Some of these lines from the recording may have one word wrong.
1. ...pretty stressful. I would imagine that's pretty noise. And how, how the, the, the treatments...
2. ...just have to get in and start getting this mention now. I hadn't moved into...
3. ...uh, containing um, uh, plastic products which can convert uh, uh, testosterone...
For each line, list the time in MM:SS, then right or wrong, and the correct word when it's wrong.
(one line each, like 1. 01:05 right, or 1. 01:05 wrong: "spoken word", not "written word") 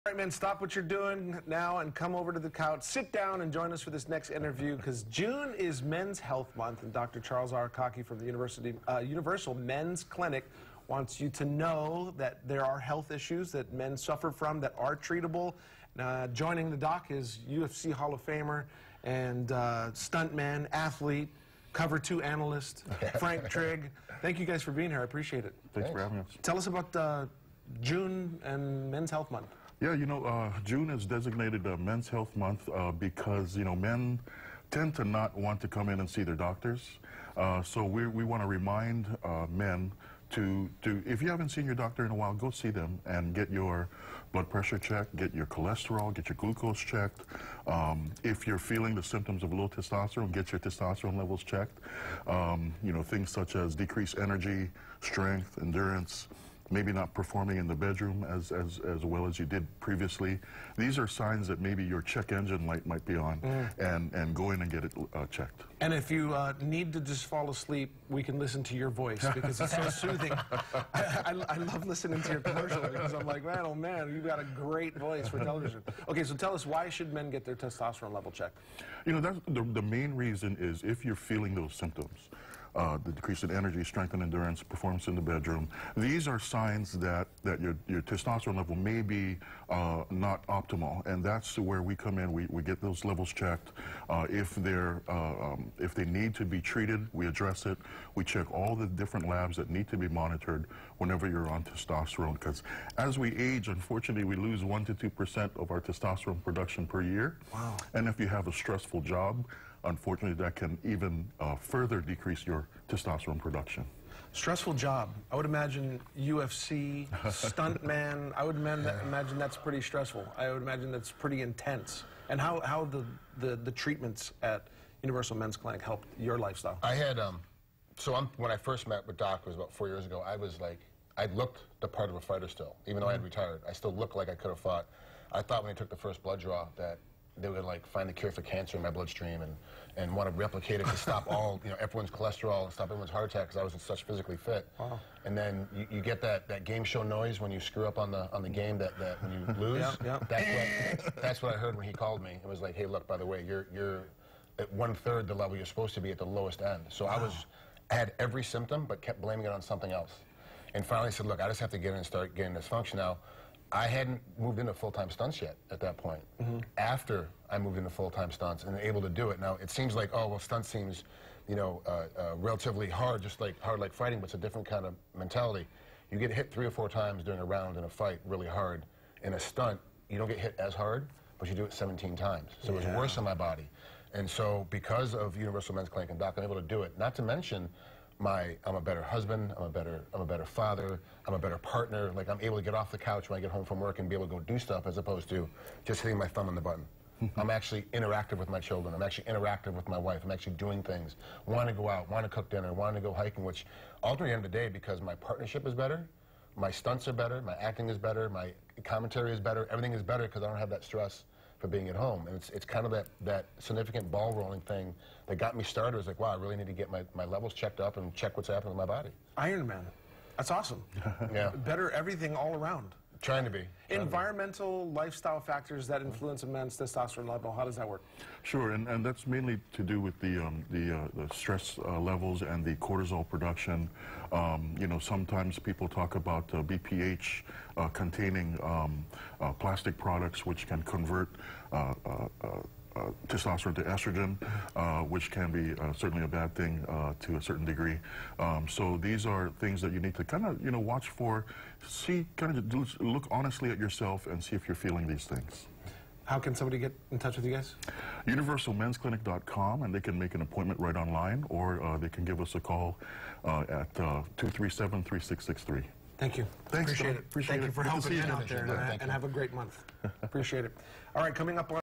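1. 01:59 wrong: "intense", not "noise"
2. 02:41 wrong: "function", not "mention"
3. 03:57 right.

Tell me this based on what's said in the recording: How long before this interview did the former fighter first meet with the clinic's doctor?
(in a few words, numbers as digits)
4 years ago.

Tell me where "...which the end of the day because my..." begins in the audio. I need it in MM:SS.
03:23.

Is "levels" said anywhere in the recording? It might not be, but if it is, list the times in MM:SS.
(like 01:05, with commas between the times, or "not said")
00:51, 01:18, 01:28, 01:33, 02:35, 03:37, 03:47, 03:51.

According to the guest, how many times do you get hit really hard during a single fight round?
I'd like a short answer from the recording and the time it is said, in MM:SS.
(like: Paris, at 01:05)
3 or 4, at 02:56.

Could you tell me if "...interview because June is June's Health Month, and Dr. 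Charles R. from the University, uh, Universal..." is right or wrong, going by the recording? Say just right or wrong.
wrong.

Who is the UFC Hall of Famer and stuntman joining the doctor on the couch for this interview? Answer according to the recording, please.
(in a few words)
Frank Trigg.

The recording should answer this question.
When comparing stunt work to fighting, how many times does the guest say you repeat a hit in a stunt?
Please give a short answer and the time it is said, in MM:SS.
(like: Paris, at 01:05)
17, at 03:01.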